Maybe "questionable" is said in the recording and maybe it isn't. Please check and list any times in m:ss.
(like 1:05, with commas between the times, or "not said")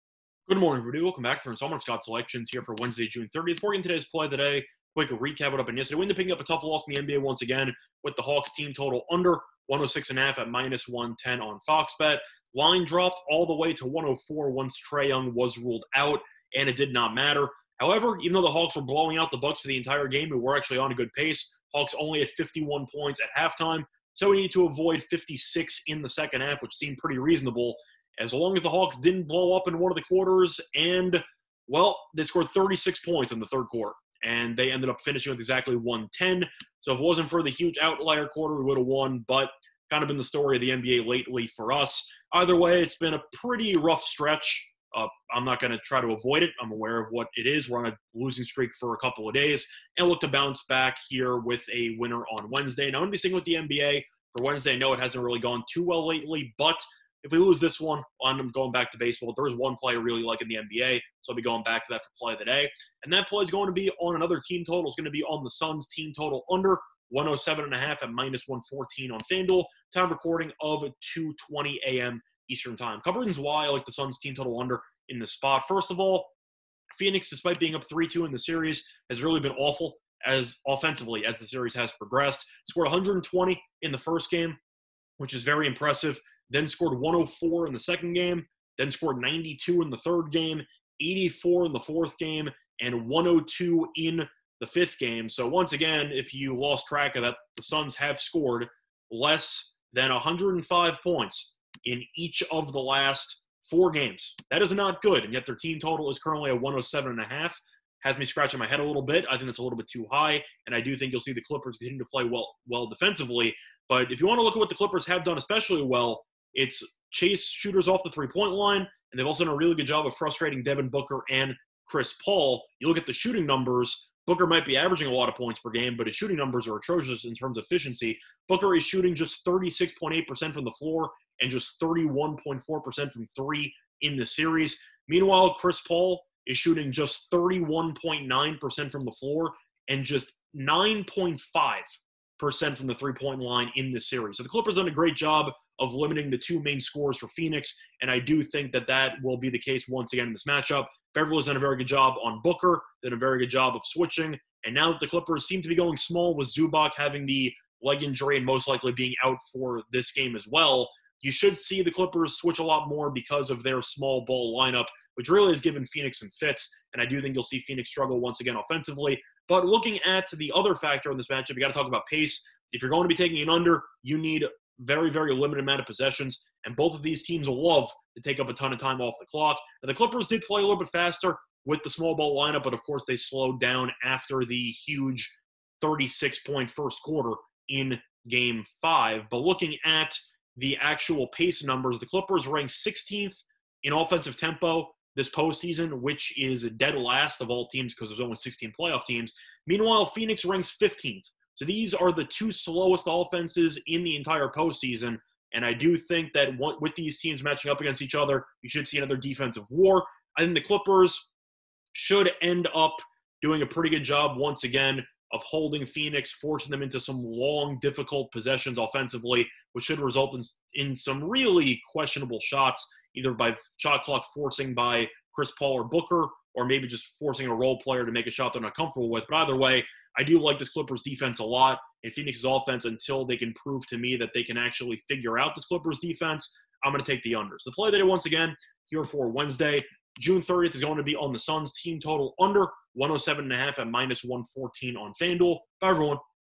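3:41.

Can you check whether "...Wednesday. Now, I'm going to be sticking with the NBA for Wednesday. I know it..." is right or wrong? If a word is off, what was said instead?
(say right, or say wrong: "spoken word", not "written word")
right.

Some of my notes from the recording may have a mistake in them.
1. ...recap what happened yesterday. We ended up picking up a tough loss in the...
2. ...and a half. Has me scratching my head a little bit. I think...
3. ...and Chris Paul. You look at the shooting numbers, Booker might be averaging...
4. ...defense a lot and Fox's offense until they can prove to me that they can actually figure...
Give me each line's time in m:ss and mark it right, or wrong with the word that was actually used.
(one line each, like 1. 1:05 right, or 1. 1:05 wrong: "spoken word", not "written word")
1. 0:05 right
2. 1:47 right
3. 2:01 right
4. 3:51 wrong: "Phoenix", not "Fox".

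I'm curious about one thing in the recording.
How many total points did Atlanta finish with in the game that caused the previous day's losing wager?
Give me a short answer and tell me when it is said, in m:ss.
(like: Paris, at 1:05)
110, at 0:35.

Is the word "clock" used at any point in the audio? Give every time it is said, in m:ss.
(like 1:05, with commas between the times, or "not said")
2:59, 3:44.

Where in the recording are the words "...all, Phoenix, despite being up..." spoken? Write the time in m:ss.
1:15.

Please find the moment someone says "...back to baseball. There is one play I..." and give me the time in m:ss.
0:58.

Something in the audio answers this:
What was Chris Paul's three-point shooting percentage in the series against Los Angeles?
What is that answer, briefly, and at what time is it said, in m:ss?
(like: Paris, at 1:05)
9.5%, at 2:20.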